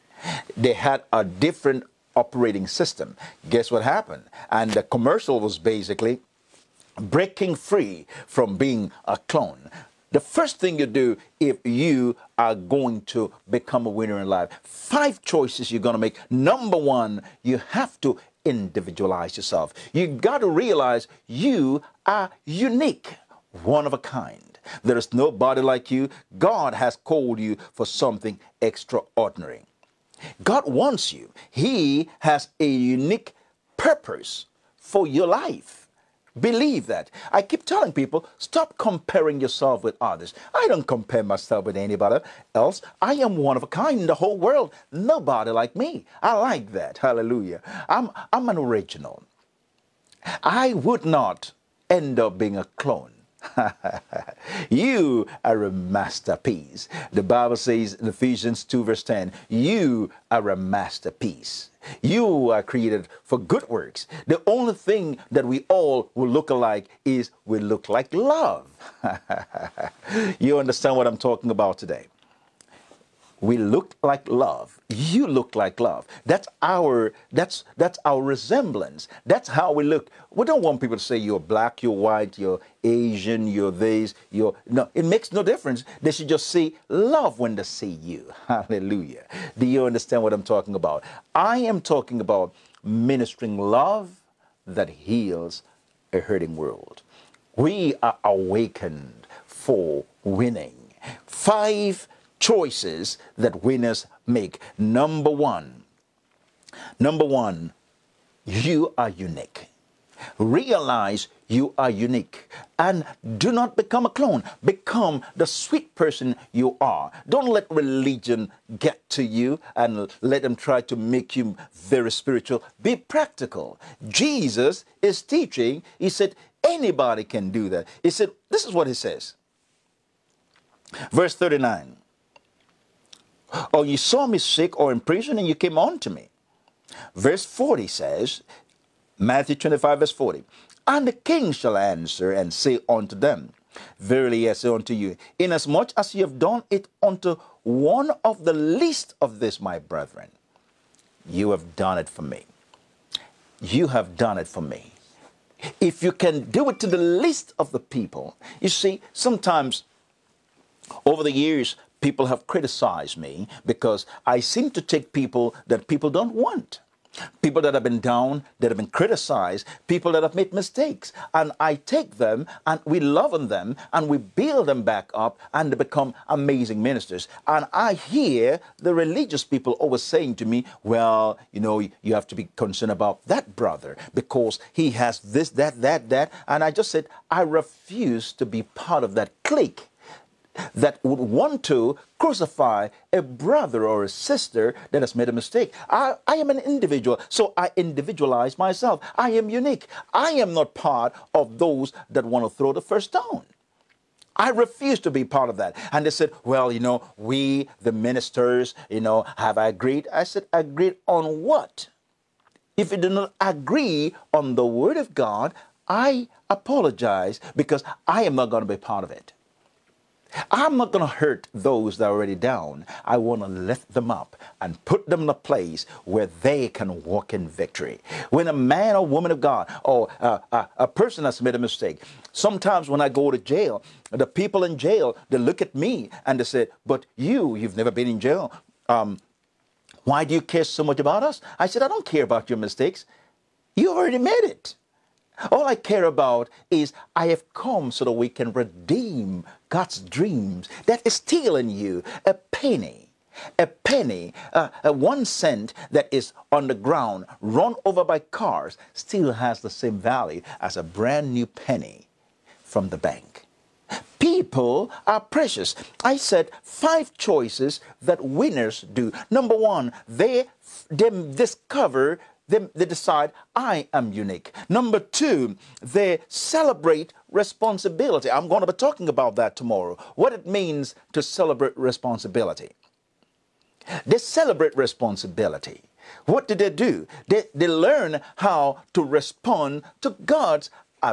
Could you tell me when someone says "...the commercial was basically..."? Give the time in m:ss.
0:04.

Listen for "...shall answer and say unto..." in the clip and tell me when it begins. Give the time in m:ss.
2:21.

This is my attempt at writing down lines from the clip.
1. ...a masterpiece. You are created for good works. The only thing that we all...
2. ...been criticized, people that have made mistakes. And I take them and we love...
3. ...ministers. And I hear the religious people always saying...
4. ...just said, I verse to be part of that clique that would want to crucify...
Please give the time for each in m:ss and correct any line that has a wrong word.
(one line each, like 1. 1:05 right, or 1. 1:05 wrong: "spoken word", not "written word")
1. 1:00 right
2. 2:48 right
3. 2:56 right
4. 3:06 wrong: "refuse", not "verse".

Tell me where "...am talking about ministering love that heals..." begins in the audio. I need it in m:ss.
1:31.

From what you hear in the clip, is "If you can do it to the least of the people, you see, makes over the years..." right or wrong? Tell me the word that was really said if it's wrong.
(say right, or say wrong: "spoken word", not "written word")
wrong: "sometimes", not "makes".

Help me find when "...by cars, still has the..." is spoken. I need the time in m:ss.
4:18.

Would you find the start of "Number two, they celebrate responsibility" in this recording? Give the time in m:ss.
4:34.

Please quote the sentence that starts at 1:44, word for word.
Number one, number one, you are unique.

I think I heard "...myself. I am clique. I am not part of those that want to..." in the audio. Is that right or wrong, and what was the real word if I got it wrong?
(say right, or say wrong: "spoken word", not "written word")
wrong: "unique", not "clique".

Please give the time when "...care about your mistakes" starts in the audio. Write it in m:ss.
4:02.